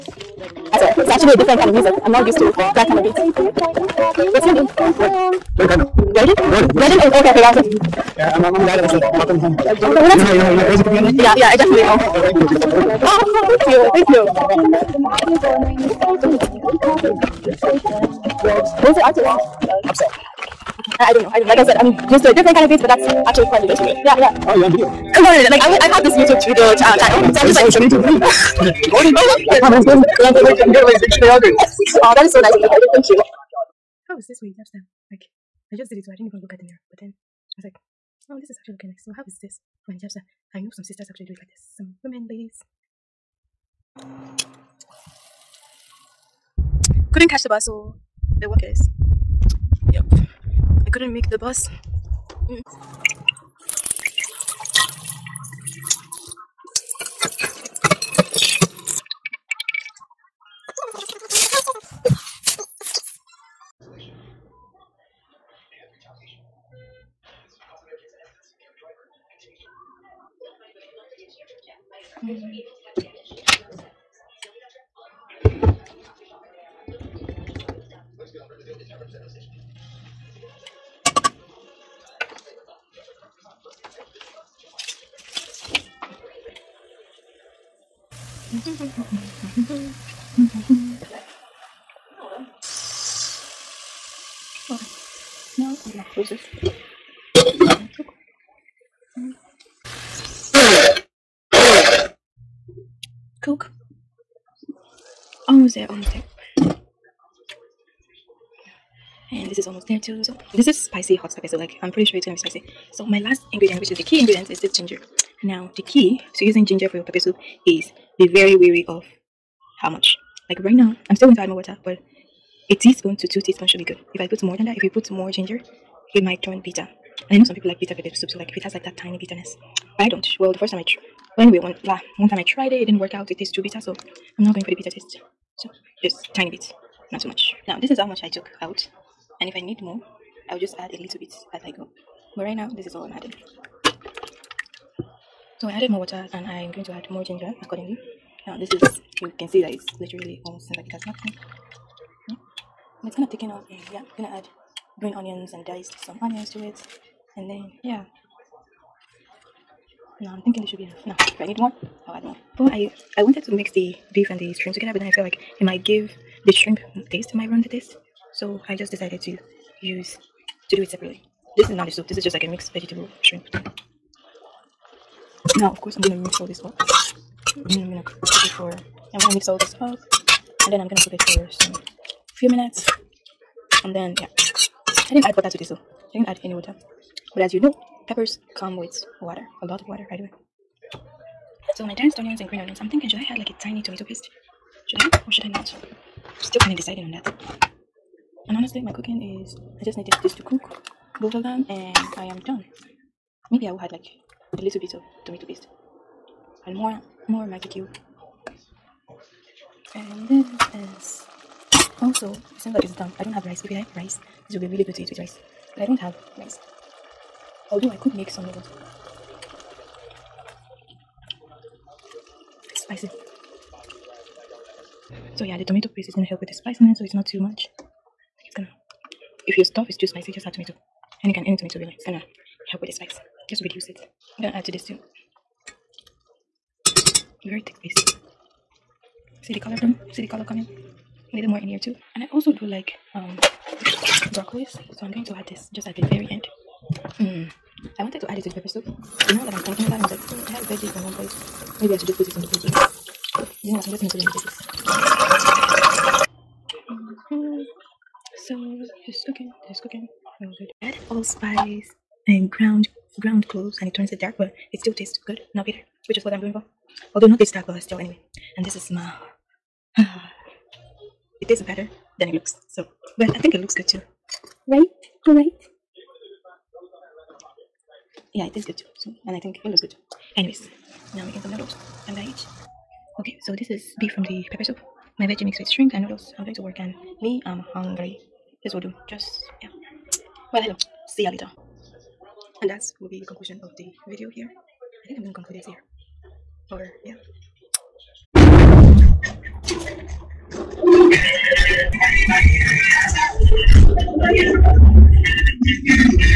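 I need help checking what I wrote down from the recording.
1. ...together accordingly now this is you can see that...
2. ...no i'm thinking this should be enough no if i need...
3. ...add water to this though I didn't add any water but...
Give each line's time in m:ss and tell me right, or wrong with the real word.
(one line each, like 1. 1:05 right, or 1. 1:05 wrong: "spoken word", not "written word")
1. 2:27 wrong: "ginger", not "together"
2. 2:40 right
3. 3:05 right.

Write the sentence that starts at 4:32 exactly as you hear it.
So well I think it looks good too.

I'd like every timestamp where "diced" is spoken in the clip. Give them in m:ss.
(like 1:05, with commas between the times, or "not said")
2:35, 3:11.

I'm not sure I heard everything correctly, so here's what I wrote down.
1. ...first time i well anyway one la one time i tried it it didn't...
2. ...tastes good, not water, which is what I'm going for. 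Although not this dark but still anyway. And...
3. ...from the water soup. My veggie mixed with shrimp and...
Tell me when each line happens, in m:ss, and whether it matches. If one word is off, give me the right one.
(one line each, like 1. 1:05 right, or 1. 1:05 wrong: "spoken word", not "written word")
1. 2:10 right
2. 4:24 wrong: "bitter", not "water"
3. 4:44 wrong: "pepper", not "water".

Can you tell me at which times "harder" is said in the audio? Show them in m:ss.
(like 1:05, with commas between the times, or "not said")
not said.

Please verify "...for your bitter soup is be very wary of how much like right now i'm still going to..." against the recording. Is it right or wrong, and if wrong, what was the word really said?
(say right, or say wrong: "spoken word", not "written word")
wrong: "pepper", not "bitter".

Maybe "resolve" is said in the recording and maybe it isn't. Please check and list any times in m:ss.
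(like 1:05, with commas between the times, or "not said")
not said.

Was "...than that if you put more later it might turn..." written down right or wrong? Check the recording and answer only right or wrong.
wrong.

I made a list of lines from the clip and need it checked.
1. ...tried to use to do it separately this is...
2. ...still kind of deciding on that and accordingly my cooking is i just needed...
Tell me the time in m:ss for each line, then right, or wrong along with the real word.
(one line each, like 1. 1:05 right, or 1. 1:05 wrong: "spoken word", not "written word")
1. 2:48 wrong: "decided", not "tried"
2. 3:16 wrong: "honestly", not "accordingly".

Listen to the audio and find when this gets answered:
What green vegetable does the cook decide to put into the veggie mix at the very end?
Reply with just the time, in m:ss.
4:04.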